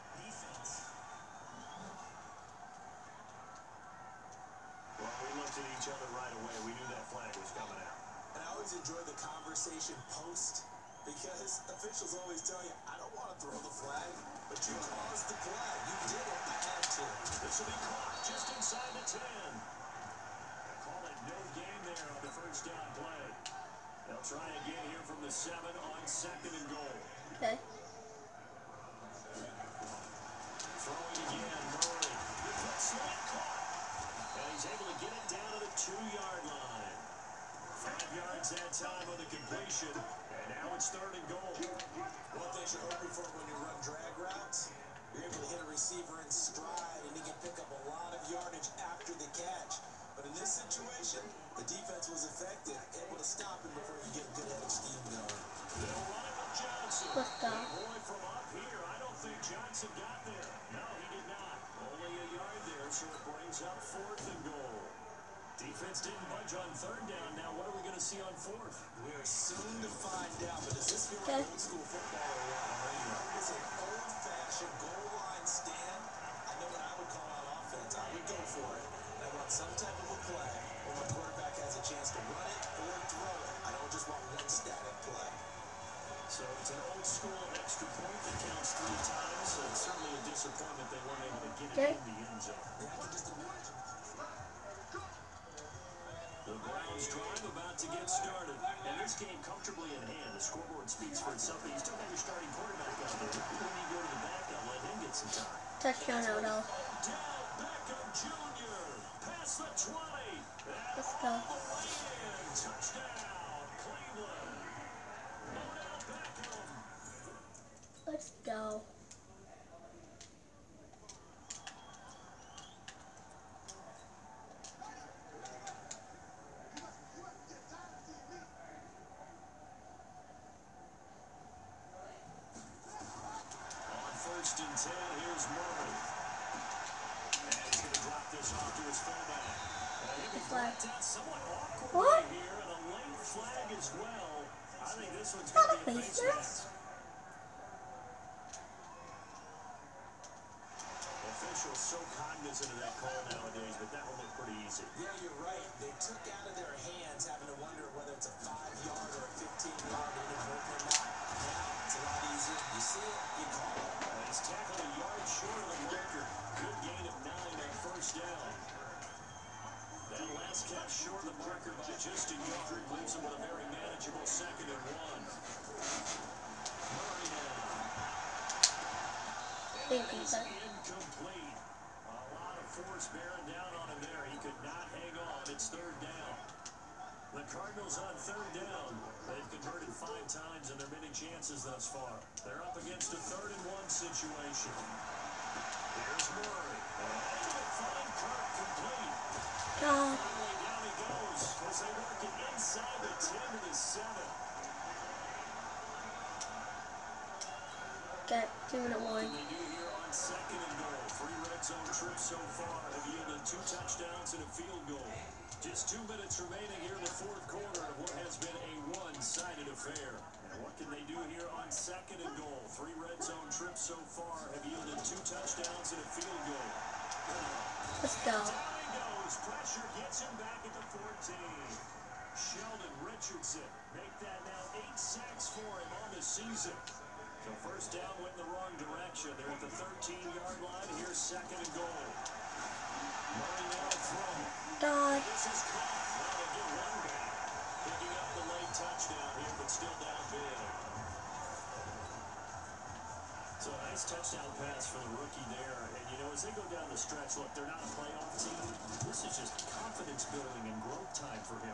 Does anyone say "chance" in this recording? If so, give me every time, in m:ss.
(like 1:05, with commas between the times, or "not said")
1:21, 3:11.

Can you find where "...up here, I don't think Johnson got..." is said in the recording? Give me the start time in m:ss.
0:58.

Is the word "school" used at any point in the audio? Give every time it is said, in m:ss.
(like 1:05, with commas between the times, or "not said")
1:11, 1:27.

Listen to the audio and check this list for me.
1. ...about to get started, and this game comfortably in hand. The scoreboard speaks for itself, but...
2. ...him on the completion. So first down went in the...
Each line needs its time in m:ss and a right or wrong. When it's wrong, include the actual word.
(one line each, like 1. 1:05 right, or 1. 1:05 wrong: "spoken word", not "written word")
1. 1:37 right
2. 3:55 wrong: "season", not "completion".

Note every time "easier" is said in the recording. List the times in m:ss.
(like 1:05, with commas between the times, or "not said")
2:42.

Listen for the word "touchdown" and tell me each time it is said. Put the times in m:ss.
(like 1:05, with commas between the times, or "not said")
1:45, 3:45, 4:08, 4:14.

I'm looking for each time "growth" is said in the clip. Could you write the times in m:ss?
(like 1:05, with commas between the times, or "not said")
4:20.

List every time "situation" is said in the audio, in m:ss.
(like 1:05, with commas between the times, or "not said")
0:50, 3:13.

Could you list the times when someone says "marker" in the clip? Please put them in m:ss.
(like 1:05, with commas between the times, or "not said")
2:51.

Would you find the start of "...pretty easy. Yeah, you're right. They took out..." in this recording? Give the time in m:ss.
2:34.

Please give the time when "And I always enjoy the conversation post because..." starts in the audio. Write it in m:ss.
0:08.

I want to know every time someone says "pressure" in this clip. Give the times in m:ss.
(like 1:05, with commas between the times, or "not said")
3:49.